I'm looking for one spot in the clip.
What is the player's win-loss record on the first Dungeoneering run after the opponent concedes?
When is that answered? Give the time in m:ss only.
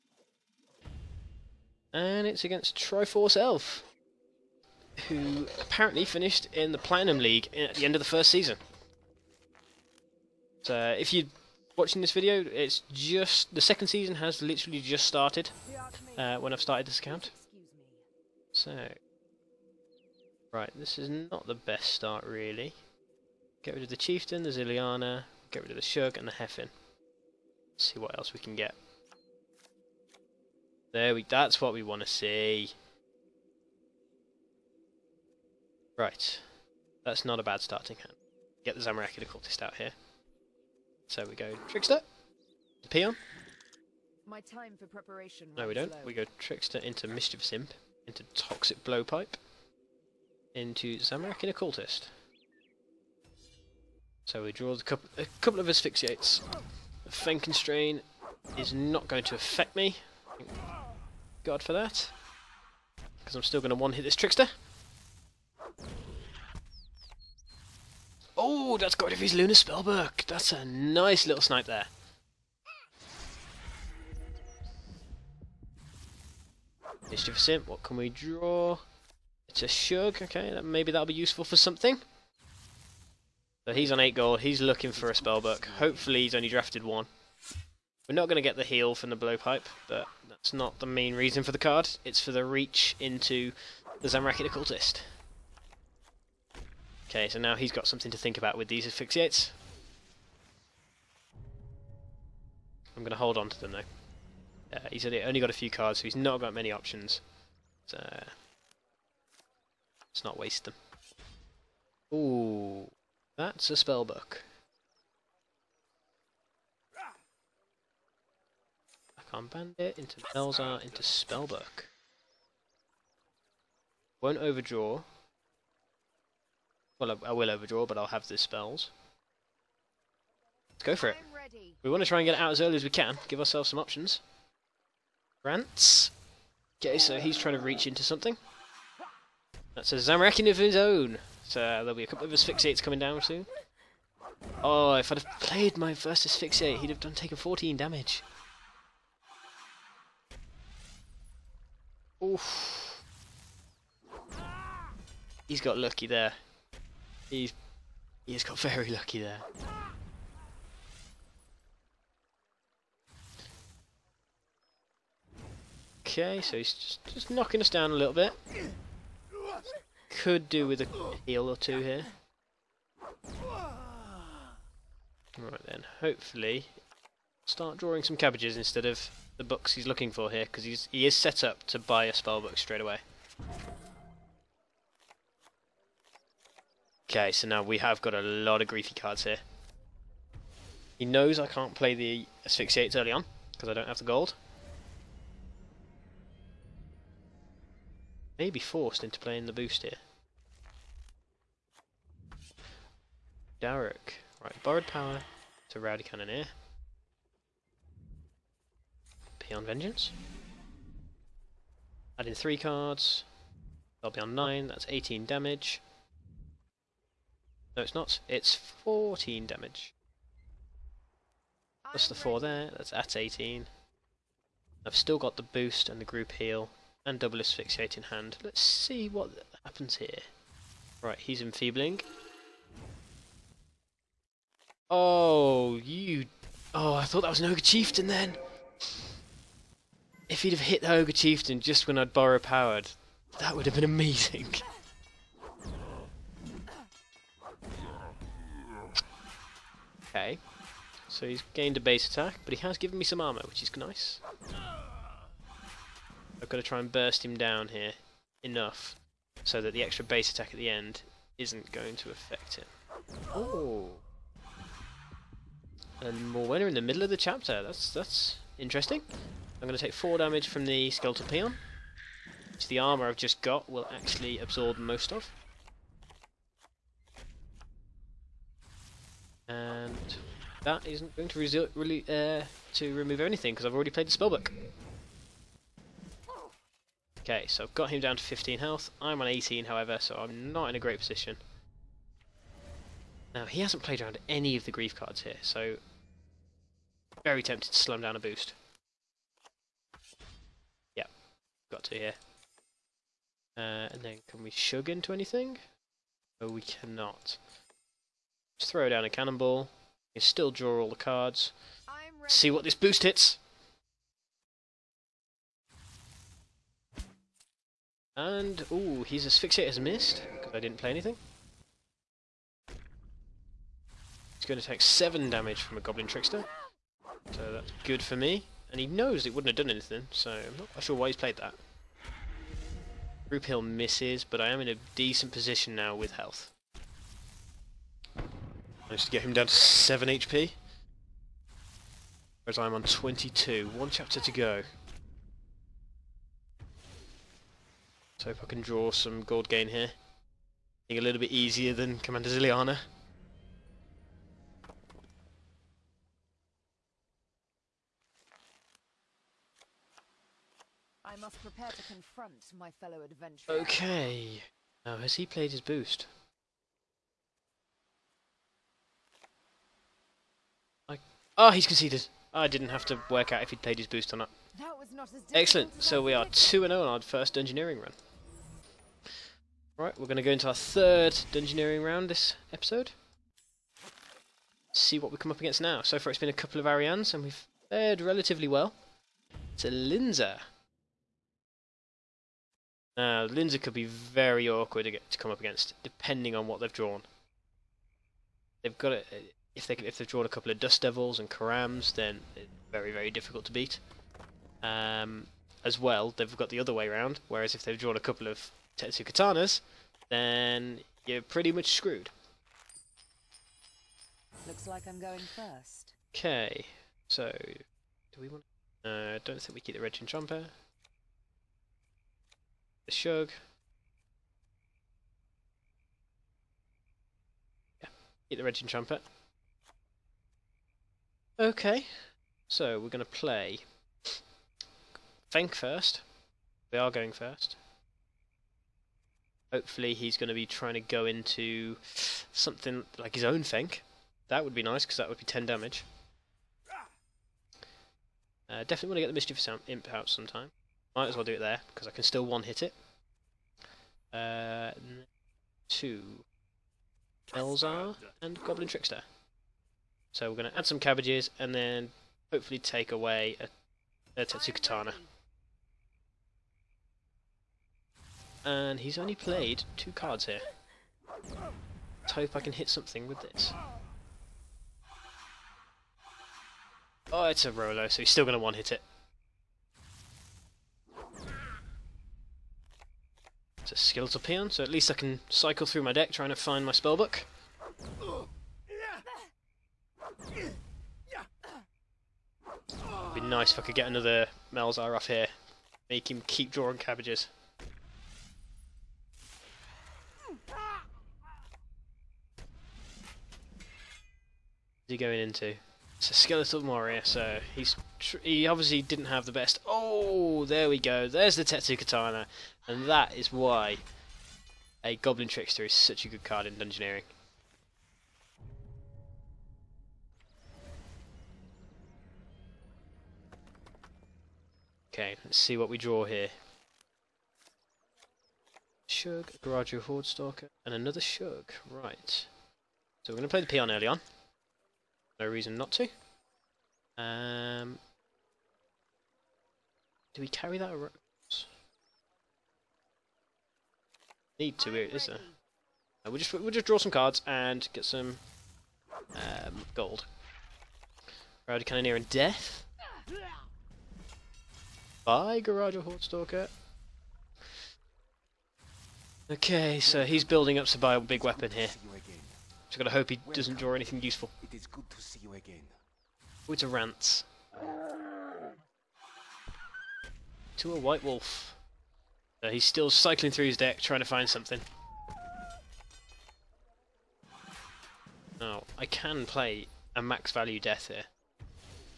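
6:16.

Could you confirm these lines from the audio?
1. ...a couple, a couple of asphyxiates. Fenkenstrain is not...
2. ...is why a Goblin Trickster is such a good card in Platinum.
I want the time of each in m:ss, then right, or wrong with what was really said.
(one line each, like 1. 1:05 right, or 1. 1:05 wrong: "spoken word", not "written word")
1. 0:54 right
2. 8:33 wrong: "Dungeoneering", not "Platinum".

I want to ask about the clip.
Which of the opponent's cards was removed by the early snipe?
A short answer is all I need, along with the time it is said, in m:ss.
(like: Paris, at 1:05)
Lunar Spellbook, at 1:09.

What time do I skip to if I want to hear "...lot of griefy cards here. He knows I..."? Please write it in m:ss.
3:08.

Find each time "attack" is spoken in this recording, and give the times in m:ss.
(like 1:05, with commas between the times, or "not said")
4:12, 4:20.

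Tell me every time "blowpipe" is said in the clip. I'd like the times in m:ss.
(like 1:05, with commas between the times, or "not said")
0:48, 1:29.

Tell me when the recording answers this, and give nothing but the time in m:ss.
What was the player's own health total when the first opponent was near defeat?
5:42.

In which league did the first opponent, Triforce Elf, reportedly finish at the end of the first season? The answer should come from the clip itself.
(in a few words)
Platinum League.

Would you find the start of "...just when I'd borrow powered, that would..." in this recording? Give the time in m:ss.
4:01.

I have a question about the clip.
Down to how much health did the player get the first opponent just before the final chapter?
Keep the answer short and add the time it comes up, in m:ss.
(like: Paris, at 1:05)
7, at 5:39.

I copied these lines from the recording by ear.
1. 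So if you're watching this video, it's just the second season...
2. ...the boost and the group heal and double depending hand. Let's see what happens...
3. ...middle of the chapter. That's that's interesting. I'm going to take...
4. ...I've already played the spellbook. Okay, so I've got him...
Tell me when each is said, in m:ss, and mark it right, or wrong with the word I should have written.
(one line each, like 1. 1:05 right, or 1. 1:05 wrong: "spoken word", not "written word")
1. 0:10 right
2. 3:45 wrong: "asphyxiating", not "depending"
3. 4:26 right
4. 4:43 right.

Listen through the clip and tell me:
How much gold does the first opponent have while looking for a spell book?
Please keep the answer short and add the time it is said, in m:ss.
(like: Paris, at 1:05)
8, at 1:23.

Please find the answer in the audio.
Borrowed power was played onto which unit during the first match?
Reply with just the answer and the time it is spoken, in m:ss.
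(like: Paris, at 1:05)
Rowdy Cannoneer, at 3:25.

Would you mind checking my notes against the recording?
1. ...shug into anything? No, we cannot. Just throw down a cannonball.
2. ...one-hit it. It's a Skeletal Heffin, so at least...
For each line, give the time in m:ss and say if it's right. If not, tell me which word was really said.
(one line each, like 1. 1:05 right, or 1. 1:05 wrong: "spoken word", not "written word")
1. 5:04 right
2. 7:58 wrong: "Peon", not "Heffin".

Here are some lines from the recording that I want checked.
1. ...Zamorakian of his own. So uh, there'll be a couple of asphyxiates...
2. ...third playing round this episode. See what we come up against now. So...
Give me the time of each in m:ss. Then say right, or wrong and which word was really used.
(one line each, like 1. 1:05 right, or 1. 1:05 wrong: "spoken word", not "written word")
1. 2:19 right
2. 6:20 wrong: "dungeoneering", not "playing".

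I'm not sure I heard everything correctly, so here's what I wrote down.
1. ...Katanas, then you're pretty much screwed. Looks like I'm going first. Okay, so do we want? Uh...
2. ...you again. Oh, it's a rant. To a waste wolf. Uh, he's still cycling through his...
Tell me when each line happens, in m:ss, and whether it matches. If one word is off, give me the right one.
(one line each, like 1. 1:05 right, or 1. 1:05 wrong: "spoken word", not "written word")
1. 6:49 right
2. 9:25 wrong: "white", not "waste".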